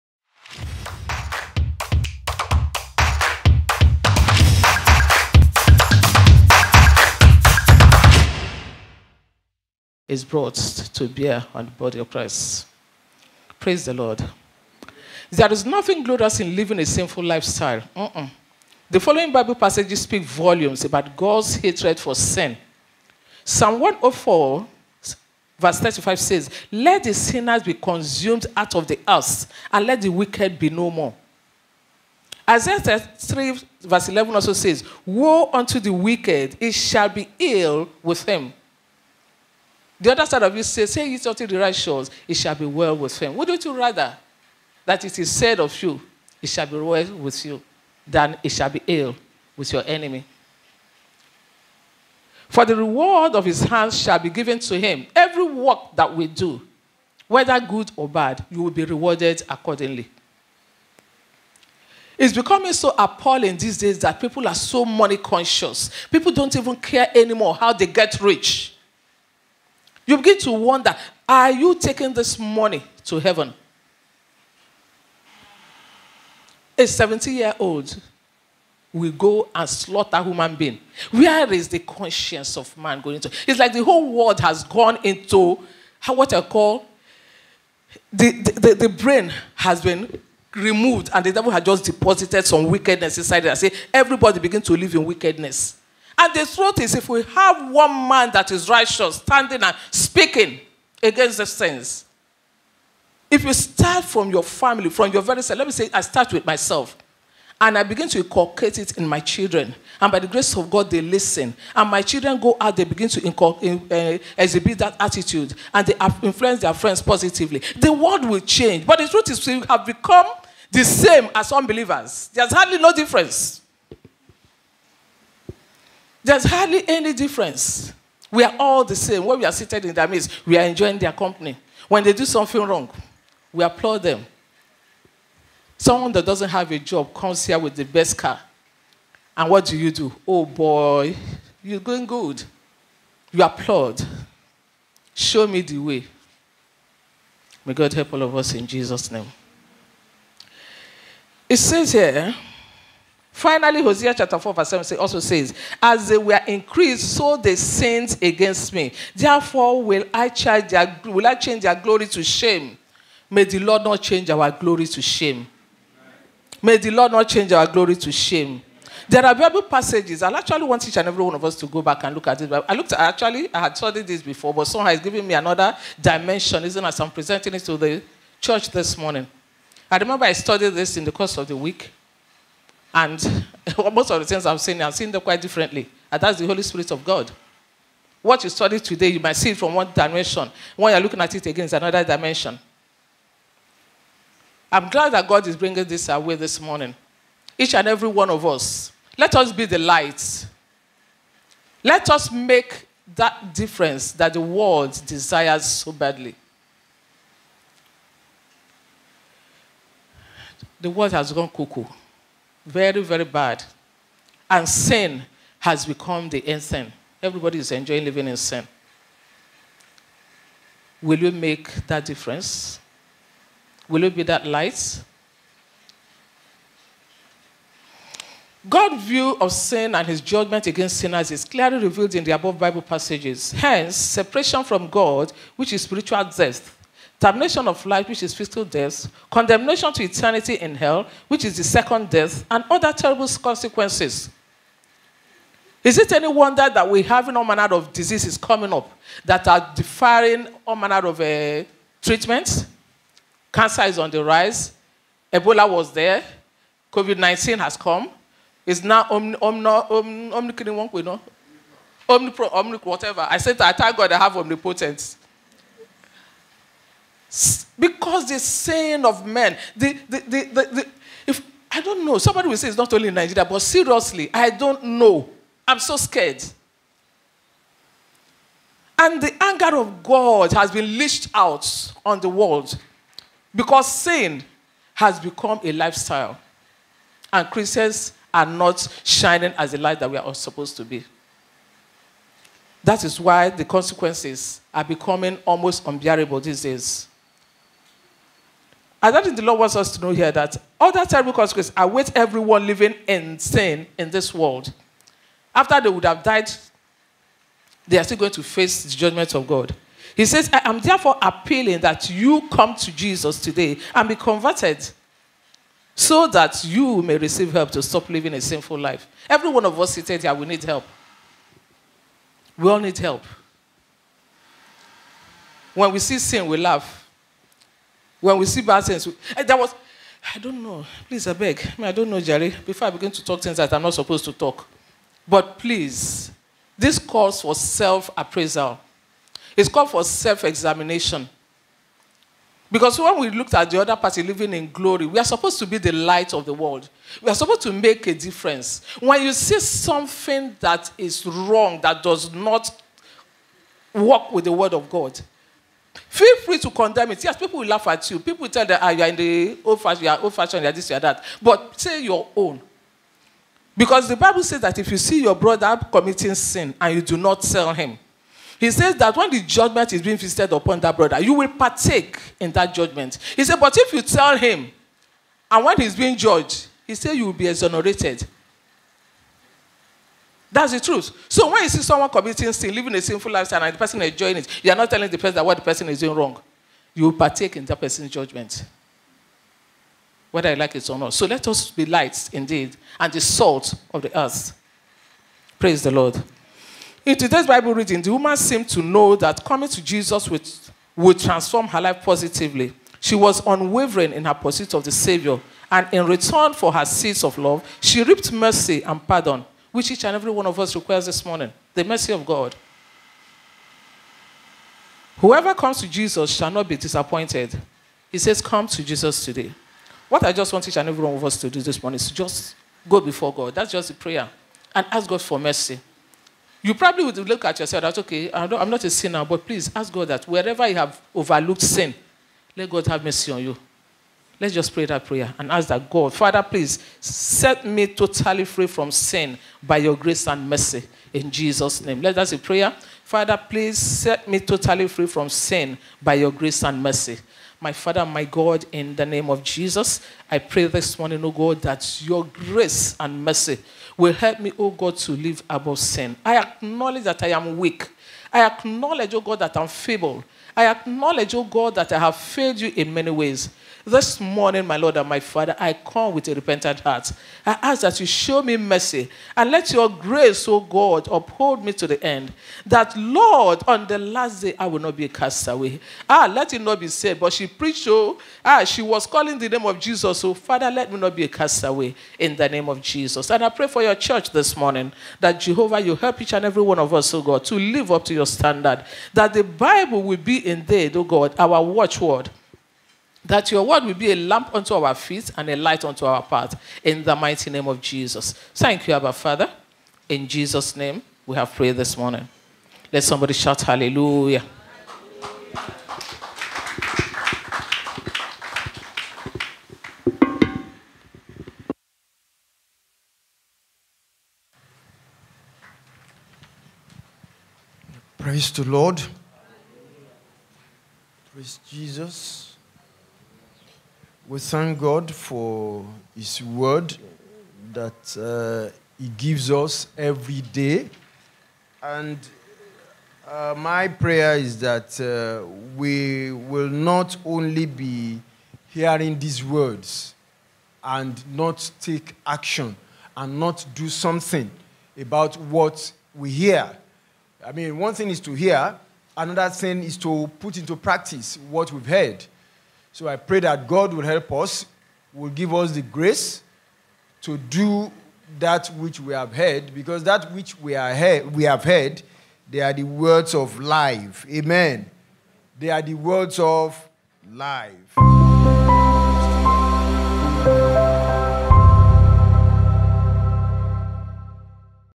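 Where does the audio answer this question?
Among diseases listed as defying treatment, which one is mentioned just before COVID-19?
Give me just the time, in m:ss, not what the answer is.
4:15.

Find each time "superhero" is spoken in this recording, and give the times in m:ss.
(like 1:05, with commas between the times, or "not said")
not said.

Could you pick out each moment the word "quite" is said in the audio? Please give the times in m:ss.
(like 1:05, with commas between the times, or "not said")
3:05.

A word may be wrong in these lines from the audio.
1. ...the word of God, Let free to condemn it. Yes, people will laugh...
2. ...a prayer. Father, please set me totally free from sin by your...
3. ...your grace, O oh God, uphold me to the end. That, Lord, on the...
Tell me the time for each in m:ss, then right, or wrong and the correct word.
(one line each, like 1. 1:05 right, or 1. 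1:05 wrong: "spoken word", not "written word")
1. 5:54 wrong: "Feel", not "Let"
2. 7:22 right
3. 7:49 right.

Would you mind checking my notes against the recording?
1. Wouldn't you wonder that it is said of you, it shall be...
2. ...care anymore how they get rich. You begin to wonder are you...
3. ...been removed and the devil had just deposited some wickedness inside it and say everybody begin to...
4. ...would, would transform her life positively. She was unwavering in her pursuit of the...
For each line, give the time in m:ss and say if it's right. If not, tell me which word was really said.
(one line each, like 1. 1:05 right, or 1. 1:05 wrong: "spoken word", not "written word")
1. 0:43 wrong: "rather", not "wonder"
2. 1:06 right
3. 1:29 right
4. 6:40 right.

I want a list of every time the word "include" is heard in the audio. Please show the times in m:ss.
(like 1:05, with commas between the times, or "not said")
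not said.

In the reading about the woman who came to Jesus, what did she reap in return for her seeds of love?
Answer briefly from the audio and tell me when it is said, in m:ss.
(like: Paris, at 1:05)
Mercy and pardon, at 6:48.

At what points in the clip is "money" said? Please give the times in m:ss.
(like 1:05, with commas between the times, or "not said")
1:04, 1:12.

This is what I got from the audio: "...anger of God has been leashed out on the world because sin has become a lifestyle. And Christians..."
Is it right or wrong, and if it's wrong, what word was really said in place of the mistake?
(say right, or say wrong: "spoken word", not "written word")
right.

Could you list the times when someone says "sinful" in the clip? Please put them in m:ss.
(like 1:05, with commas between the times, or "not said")
0:16, 5:18, 6:23.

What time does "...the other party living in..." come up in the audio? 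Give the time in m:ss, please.
5:43.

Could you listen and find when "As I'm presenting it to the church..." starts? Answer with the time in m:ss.
2:56.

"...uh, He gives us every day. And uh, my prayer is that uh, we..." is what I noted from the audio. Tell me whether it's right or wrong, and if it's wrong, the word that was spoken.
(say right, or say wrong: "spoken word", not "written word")
right.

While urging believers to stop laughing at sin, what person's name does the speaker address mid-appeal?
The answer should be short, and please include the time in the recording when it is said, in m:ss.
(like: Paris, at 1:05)
Jerry, at 5:32.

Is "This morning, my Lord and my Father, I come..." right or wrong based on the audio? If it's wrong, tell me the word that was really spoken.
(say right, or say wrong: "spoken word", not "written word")
right.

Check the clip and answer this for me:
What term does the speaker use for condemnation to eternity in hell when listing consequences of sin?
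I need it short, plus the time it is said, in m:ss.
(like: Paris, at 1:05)
the second death, at 4:01.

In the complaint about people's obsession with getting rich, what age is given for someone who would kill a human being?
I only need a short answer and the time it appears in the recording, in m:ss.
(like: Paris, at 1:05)
70, at 1:16.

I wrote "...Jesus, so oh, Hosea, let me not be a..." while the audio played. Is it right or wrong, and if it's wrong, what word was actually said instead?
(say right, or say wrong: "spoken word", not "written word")
wrong: "Father", not "Hosea".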